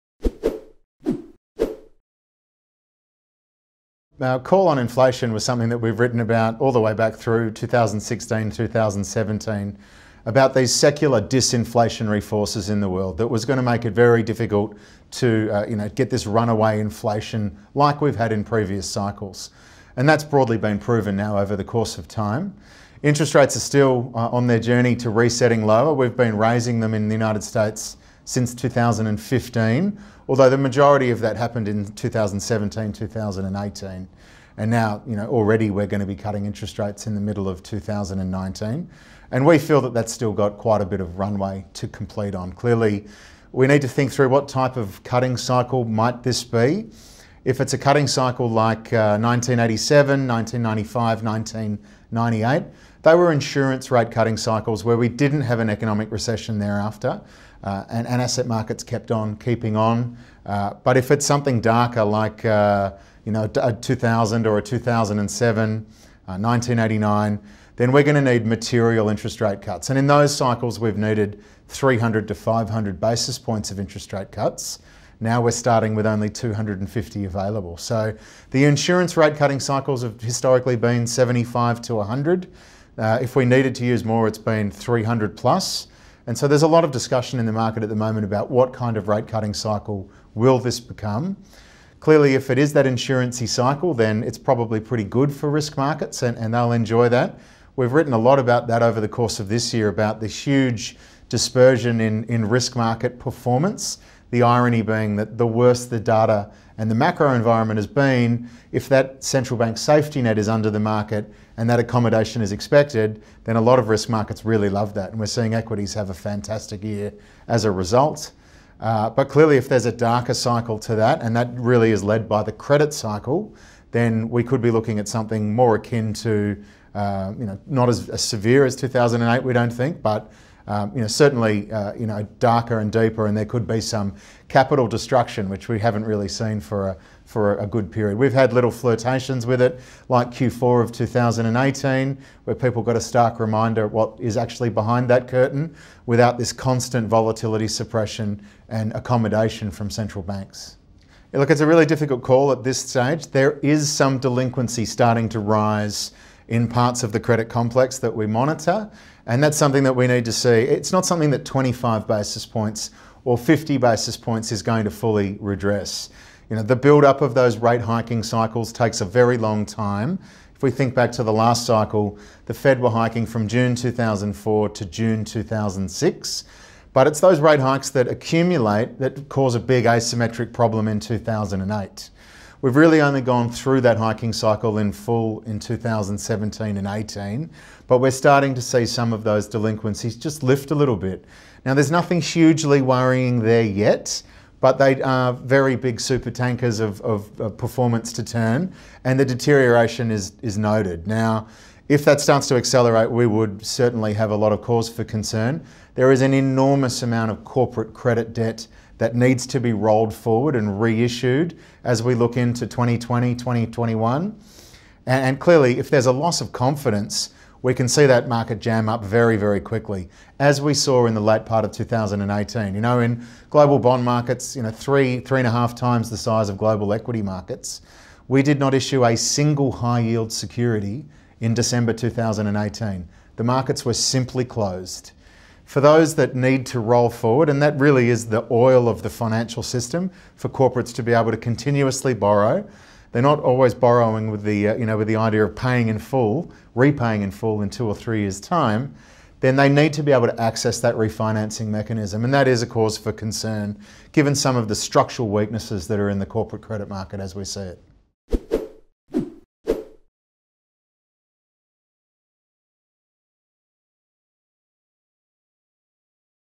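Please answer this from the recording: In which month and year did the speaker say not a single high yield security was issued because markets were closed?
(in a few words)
December 2018.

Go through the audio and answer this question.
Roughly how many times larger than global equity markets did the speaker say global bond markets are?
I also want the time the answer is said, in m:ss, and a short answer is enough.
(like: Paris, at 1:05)
3 to 3.5 times, at 3:44.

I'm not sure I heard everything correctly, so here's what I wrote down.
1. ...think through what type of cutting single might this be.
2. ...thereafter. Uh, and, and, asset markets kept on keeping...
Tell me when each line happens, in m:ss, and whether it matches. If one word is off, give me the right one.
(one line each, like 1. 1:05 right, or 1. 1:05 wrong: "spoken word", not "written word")
1. 0:43 wrong: "cycle", not "single"
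2. 0:56 right.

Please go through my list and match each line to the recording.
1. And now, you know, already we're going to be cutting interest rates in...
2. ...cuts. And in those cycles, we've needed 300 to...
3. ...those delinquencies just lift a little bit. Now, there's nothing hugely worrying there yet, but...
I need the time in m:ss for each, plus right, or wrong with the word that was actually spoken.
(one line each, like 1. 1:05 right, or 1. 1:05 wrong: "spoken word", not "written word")
1. 0:34 right
2. 1:09 right
3. 3:09 right.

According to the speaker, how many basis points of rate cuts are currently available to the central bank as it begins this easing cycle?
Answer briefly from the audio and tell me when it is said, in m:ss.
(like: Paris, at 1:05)
250, at 1:16.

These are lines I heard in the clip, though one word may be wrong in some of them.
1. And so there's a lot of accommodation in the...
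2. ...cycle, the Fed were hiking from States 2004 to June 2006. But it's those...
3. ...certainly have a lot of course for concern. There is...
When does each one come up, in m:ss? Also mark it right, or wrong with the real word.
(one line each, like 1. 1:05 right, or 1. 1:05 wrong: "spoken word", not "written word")
1. 1:26 wrong: "discussion", not "accommodation"
2. 2:51 wrong: "June", not "States"
3. 3:23 wrong: "cause", not "course".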